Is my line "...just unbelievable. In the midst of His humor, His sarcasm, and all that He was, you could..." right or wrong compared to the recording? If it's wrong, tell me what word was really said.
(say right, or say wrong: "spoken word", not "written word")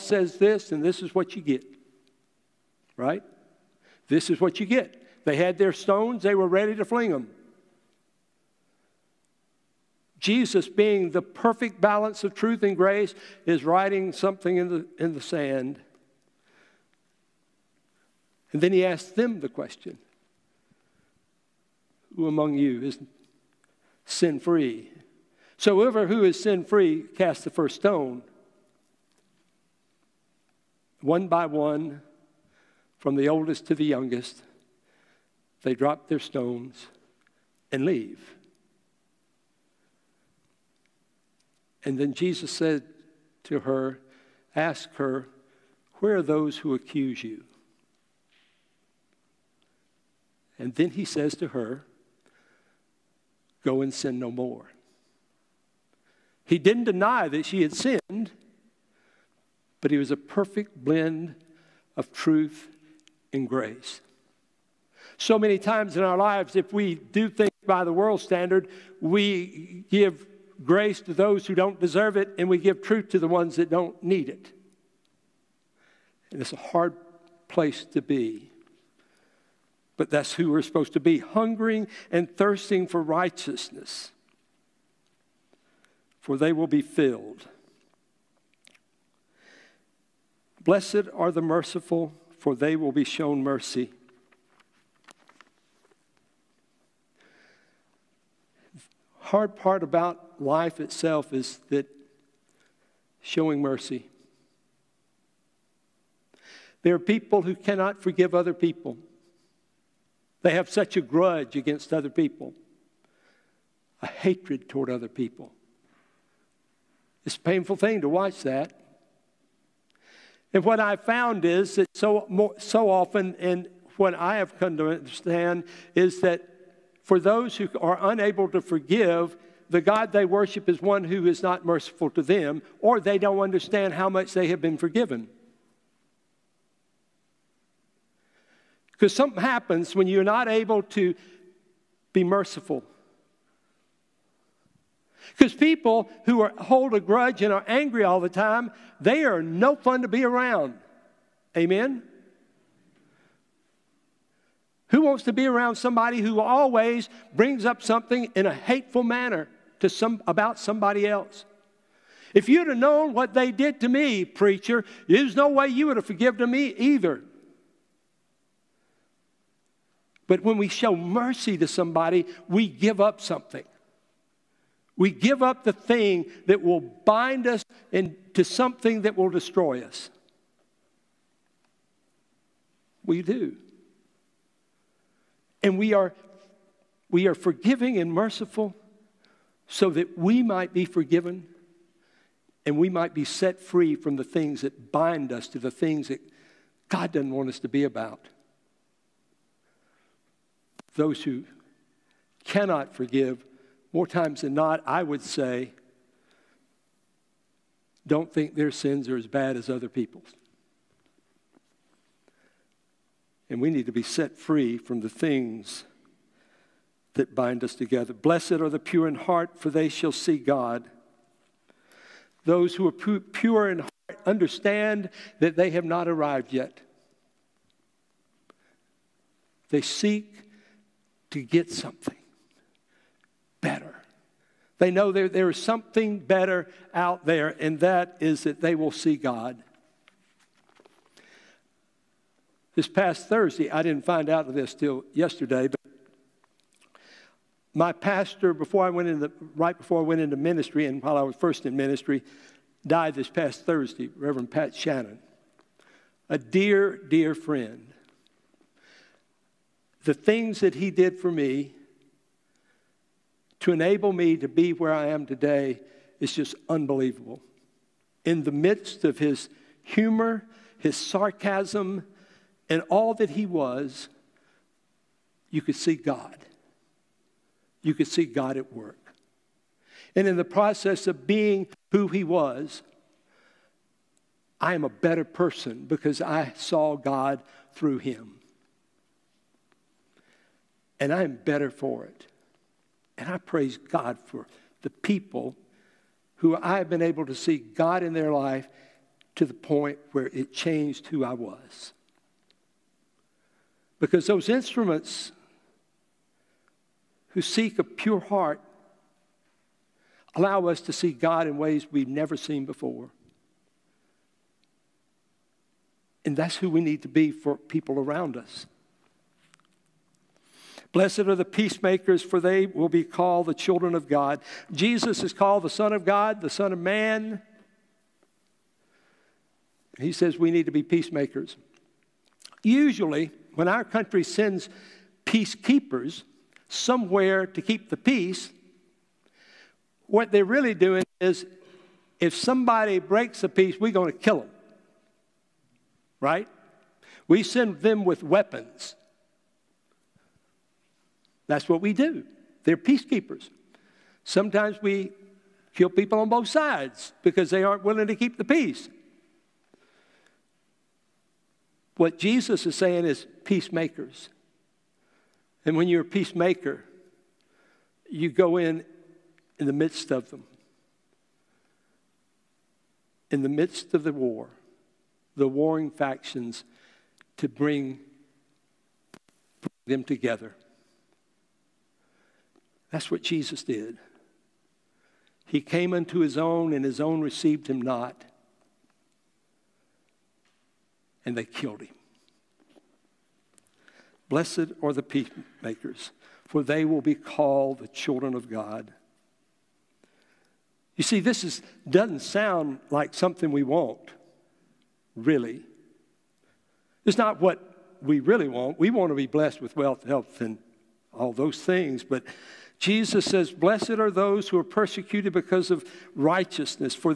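right.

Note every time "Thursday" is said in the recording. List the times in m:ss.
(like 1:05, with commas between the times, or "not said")
4:03, 4:13.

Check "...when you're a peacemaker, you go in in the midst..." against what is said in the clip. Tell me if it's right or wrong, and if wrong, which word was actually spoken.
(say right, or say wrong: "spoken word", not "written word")
right.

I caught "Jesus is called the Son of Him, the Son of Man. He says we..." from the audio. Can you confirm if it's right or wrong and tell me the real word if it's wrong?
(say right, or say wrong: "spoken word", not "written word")
wrong: "God", not "Him".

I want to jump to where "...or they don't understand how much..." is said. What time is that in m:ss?
2:12.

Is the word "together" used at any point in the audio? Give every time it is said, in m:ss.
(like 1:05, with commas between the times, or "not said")
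3:37, 6:20.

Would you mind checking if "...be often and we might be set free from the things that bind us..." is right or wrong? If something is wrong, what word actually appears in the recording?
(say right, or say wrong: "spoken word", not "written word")
wrong: "forgiven", not "often".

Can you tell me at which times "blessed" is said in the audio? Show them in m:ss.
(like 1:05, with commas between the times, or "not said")
1:30, 3:38, 5:20, 6:34, 6:49, 6:53.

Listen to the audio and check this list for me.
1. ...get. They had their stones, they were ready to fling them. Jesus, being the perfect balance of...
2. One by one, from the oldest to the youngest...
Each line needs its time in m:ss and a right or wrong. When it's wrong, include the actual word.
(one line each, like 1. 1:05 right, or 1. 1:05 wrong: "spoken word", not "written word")
1. 0:04 right
2. 0:31 right.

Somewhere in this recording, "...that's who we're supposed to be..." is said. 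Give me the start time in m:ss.
1:20.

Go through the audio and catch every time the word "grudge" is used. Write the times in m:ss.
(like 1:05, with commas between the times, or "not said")
1:51, 2:27.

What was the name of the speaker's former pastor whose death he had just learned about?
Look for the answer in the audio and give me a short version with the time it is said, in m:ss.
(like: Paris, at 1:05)
Pat Shannon, at 4:14.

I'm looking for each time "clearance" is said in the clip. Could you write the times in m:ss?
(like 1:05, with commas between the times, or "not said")
not said.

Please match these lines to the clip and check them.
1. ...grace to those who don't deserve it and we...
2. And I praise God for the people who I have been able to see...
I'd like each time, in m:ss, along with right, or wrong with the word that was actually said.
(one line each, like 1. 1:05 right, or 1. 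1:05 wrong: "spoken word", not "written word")
1. 1:10 right
2. 4:53 right.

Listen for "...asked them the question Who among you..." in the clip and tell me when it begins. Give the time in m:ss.
0:18.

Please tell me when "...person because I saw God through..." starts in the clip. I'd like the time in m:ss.
4:45.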